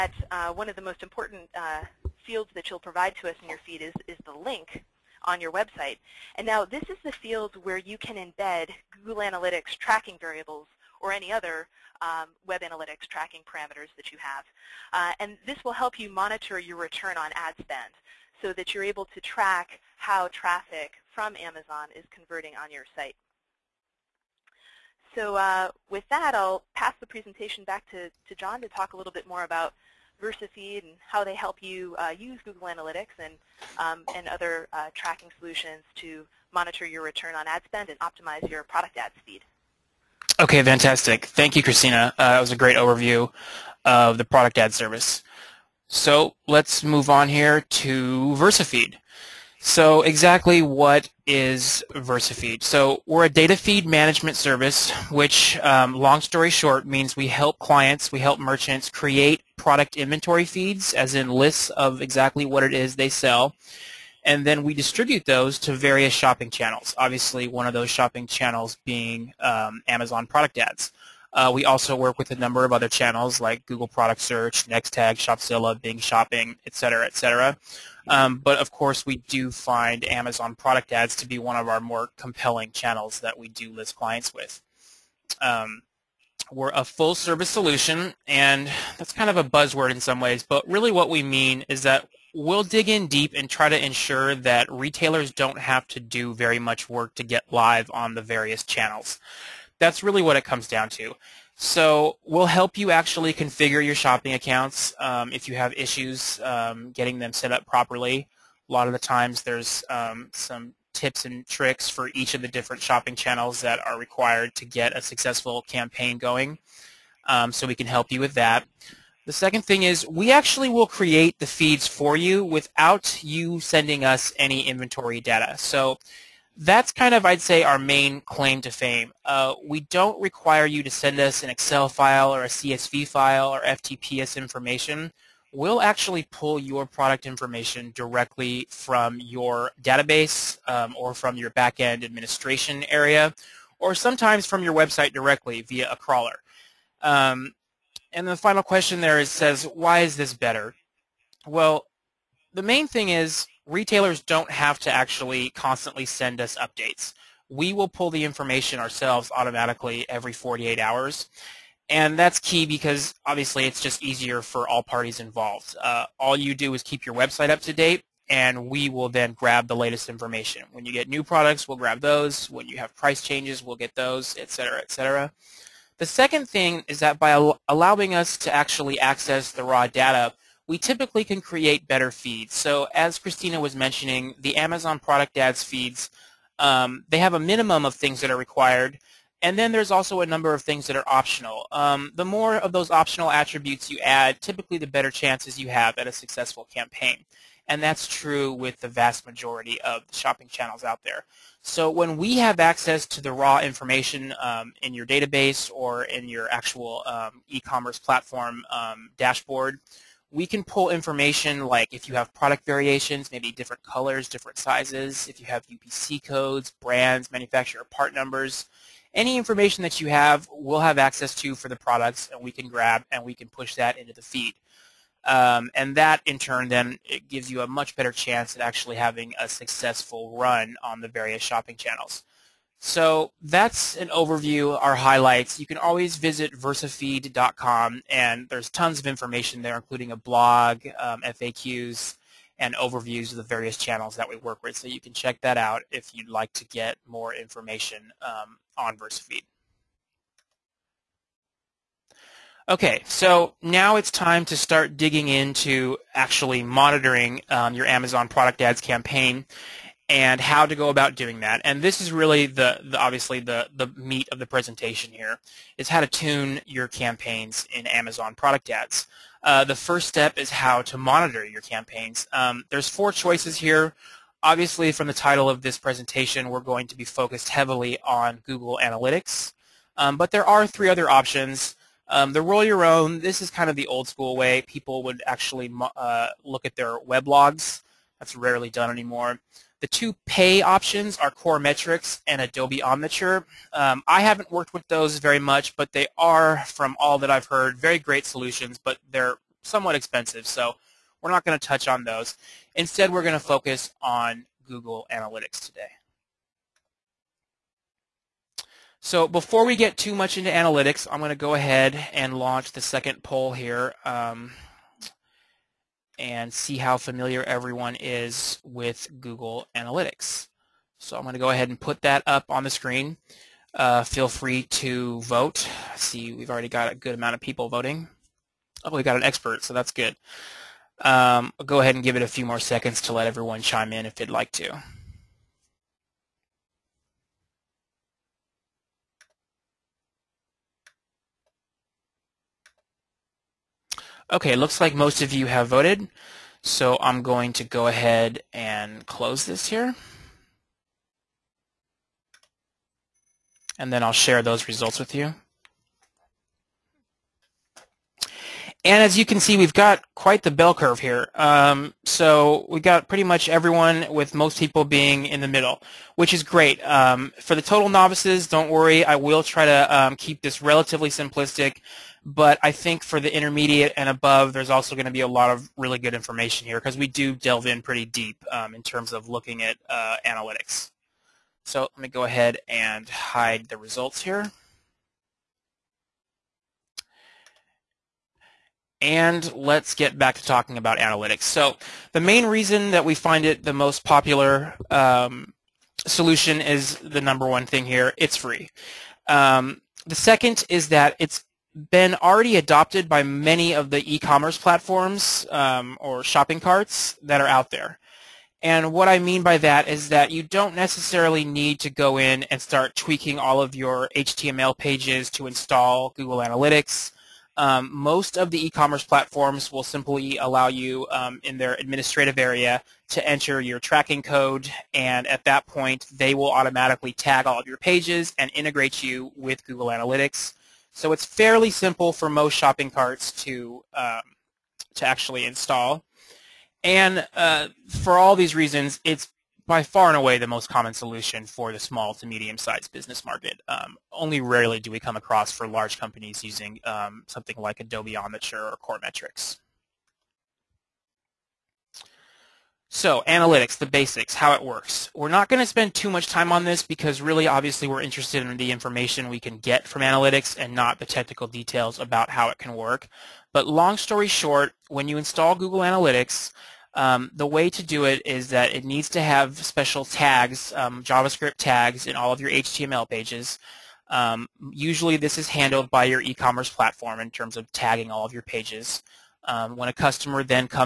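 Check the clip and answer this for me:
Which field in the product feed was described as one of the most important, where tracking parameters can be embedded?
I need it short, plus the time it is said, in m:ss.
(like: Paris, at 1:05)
Link on your website, at 0:04.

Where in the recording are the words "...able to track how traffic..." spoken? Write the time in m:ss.
0:18.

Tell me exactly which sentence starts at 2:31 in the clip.
Well, the main thing is retailers don't have to actually constantly send us updates.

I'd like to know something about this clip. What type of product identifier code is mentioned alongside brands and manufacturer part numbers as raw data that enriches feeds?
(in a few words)
UPC codes.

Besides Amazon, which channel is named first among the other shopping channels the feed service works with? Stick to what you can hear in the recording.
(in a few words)
Google Product Search.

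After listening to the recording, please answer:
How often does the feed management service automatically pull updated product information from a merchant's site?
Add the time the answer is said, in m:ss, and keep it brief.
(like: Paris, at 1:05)
Every 48 hours, at 2:40.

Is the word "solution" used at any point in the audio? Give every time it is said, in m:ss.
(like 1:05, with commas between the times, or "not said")
0:35, 1:27, 4:58, 6:36, 7:20.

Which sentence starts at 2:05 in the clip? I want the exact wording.
So that's kind of, I'd say, our main claim to fame.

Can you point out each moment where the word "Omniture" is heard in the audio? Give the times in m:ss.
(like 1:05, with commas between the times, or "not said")
4:52, 7:28.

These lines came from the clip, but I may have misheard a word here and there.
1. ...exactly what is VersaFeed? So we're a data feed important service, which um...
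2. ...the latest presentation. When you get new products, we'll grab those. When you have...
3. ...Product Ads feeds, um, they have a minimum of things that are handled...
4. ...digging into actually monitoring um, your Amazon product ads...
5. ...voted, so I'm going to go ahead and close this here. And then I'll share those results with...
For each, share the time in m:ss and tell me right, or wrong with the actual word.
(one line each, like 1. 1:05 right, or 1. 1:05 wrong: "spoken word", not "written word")
1. 0:50 wrong: "management", not "important"
2. 2:49 wrong: "information", not "presentation"
3. 3:04 wrong: "required", not "handled"
4. 4:14 right
5. 5:45 right.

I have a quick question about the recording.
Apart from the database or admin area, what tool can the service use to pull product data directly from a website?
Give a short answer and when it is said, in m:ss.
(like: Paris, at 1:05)
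A crawler, at 2:25.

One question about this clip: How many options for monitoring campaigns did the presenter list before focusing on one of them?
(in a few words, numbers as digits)
4.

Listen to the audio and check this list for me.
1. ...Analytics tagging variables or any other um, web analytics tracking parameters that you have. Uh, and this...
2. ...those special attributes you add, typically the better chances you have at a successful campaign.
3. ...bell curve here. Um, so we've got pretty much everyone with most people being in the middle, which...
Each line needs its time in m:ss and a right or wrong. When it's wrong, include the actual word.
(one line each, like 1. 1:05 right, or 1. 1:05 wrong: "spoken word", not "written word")
1. 0:09 wrong: "tracking", not "tagging"
2. 3:12 wrong: "optional", not "special"
3. 6:00 right.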